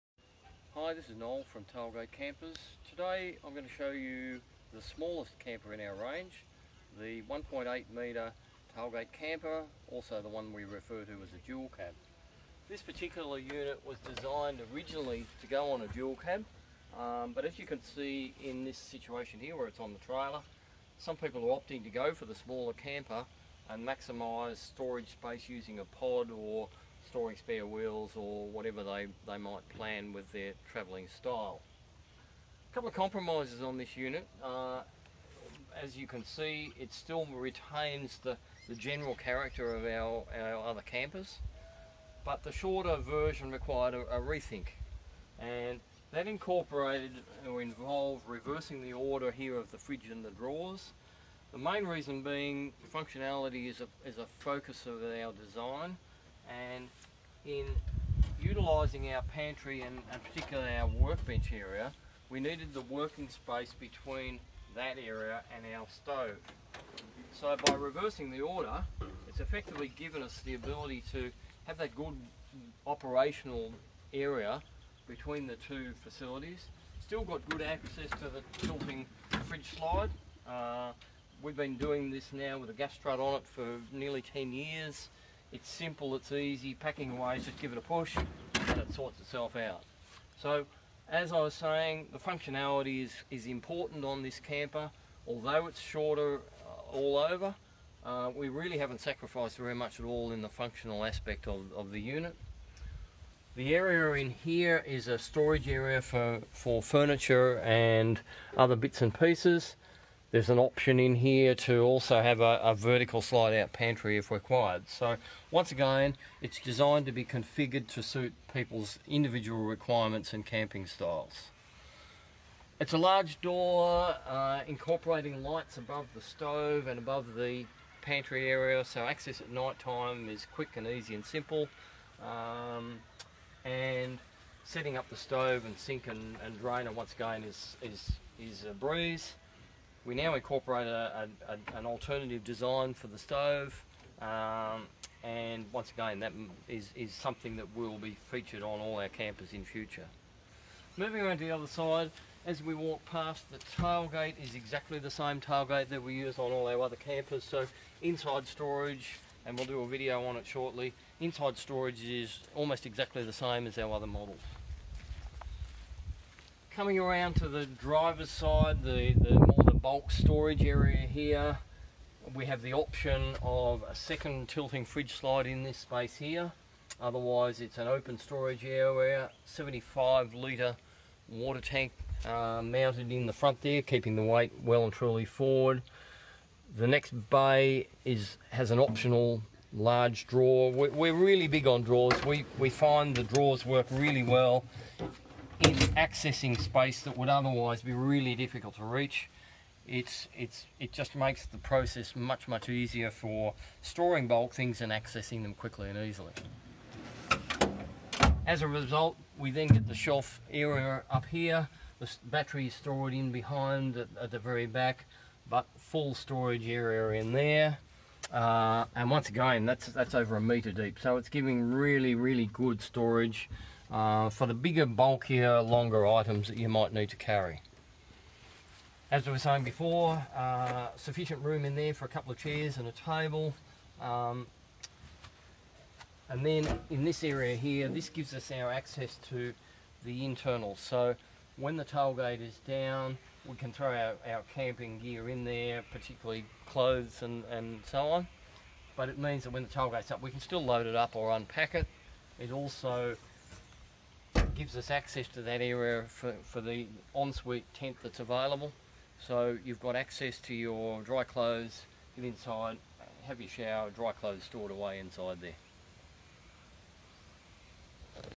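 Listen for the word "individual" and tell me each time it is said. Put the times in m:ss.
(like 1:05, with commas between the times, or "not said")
1:59.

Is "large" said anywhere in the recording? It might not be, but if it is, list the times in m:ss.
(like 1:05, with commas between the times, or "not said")
2:02, 3:09.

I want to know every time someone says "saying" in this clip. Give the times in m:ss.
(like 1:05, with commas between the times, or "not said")
1:31, 3:49.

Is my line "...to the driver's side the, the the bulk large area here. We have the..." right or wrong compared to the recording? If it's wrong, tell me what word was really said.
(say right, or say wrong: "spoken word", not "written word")
wrong: "storage", not "large".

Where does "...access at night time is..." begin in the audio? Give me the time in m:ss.
2:09.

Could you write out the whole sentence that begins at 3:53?
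Um, and then in this area here, this gives us our access to the internal.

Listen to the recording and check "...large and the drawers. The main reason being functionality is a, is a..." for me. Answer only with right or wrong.
wrong.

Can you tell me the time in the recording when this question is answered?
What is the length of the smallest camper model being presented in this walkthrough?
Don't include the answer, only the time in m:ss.
0:07.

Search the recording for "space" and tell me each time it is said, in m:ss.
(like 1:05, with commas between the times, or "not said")
0:25, 1:03, 2:55, 3:16.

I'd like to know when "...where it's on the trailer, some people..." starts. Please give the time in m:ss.
0:19.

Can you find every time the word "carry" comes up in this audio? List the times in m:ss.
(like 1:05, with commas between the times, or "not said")
3:47.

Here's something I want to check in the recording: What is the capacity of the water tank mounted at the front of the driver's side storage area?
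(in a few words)
75 litres.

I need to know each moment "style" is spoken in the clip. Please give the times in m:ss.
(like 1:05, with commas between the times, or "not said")
0:31, 2:00.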